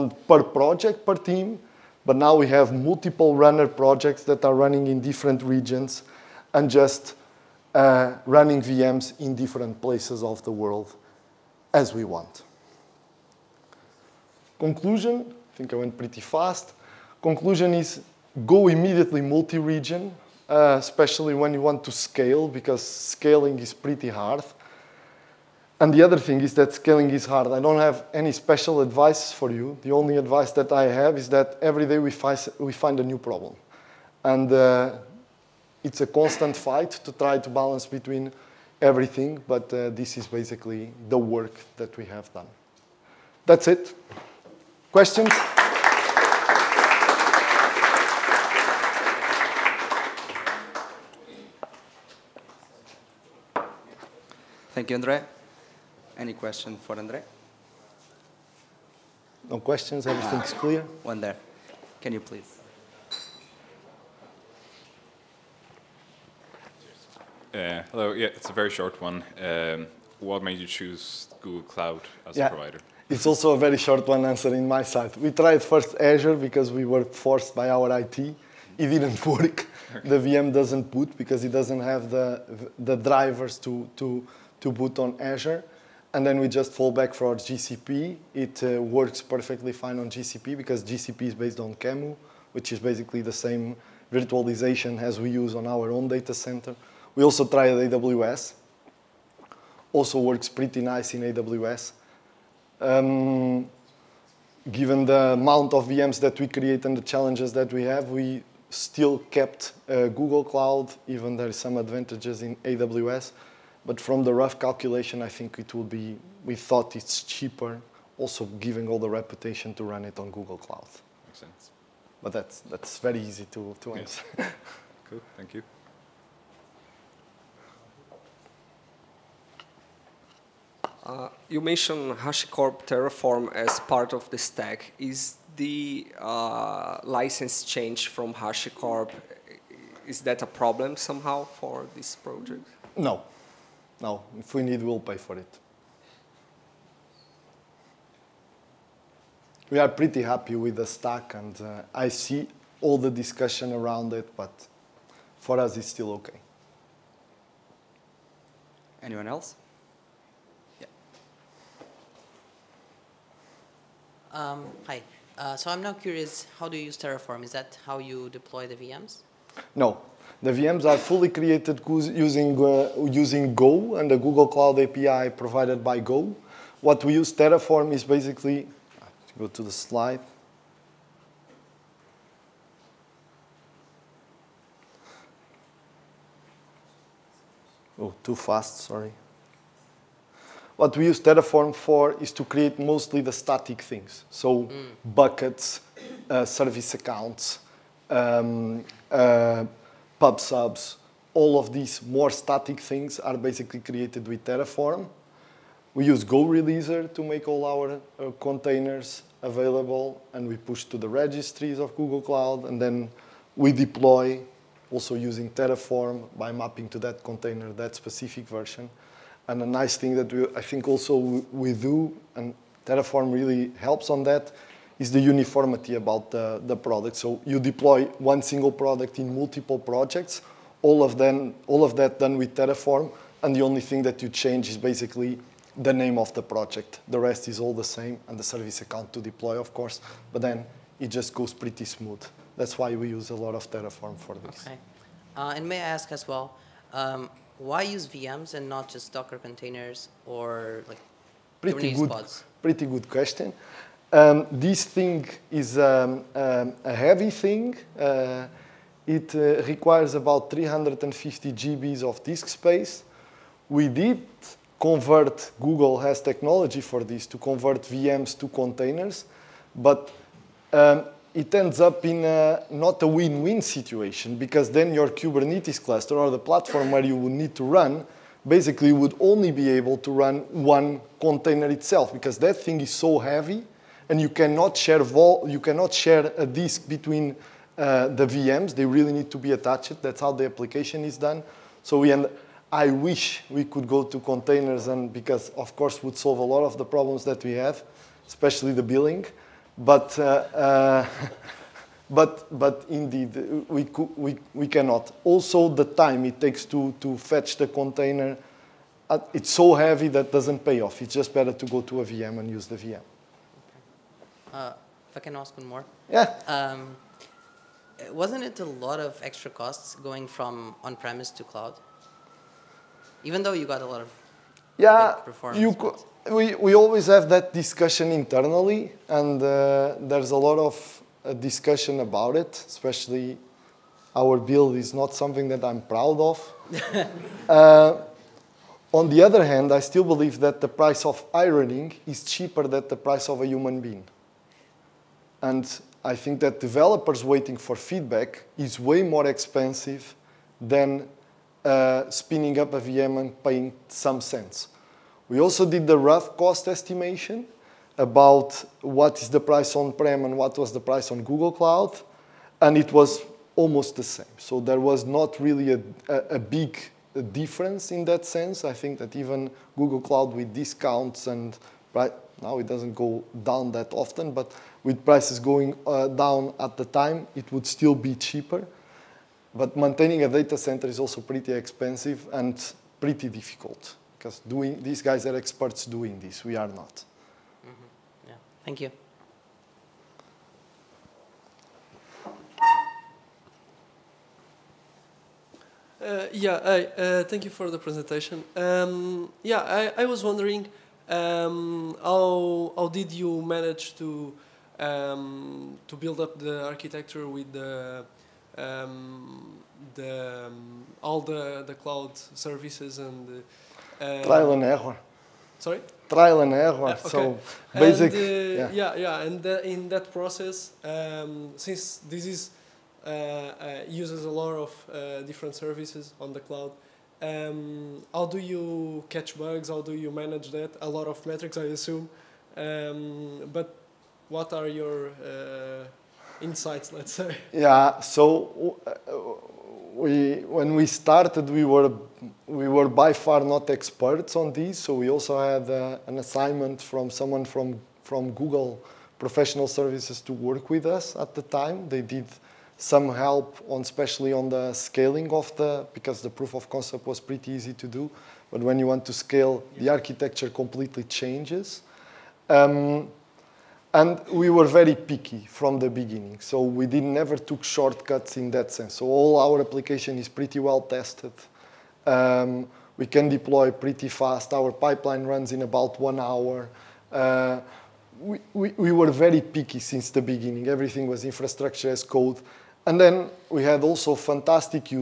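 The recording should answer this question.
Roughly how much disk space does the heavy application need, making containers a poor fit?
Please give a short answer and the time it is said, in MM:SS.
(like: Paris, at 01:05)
350 GB, at 04:20.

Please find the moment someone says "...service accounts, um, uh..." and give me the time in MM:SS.
03:16.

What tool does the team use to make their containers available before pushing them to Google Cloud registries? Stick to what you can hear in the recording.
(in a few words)
GoReleaser.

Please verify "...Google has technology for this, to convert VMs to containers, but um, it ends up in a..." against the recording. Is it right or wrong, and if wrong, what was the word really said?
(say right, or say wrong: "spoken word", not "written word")
right.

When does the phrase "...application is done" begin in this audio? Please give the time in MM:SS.
04:50.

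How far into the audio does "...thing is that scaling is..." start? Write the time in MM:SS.
00:26.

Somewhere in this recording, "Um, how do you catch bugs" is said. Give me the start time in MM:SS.
07:07.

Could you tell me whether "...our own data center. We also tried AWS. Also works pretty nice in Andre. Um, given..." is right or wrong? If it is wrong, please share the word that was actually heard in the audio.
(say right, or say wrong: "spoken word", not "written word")
wrong: "AWS", not "Andre".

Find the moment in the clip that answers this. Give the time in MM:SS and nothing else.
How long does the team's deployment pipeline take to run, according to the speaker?
07:56.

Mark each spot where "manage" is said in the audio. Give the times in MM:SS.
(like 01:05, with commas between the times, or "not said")
06:43, 07:10.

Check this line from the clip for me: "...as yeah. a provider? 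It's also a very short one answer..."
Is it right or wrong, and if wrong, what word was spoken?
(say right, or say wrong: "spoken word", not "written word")
right.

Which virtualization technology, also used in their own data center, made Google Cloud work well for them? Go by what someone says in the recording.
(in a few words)
QEMU.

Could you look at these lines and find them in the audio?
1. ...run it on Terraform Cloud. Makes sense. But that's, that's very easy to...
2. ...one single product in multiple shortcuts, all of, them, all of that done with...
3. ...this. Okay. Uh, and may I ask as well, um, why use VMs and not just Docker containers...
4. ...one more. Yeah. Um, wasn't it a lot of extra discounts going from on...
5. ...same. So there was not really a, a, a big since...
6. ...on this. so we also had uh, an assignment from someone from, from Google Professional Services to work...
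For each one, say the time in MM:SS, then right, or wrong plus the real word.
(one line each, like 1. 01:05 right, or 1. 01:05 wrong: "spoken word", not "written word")
1. 01:59 wrong: "Google", not "Terraform"
2. 03:48 wrong: "projects", not "shortcuts"
3. 04:04 right
4. 05:15 wrong: "costs", not "discounts"
5. 06:04 wrong: "difference", not "since"
6. 07:24 right.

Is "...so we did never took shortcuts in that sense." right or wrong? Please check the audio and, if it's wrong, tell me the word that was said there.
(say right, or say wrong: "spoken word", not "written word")
right.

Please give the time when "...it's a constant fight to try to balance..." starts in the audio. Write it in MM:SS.
00:35.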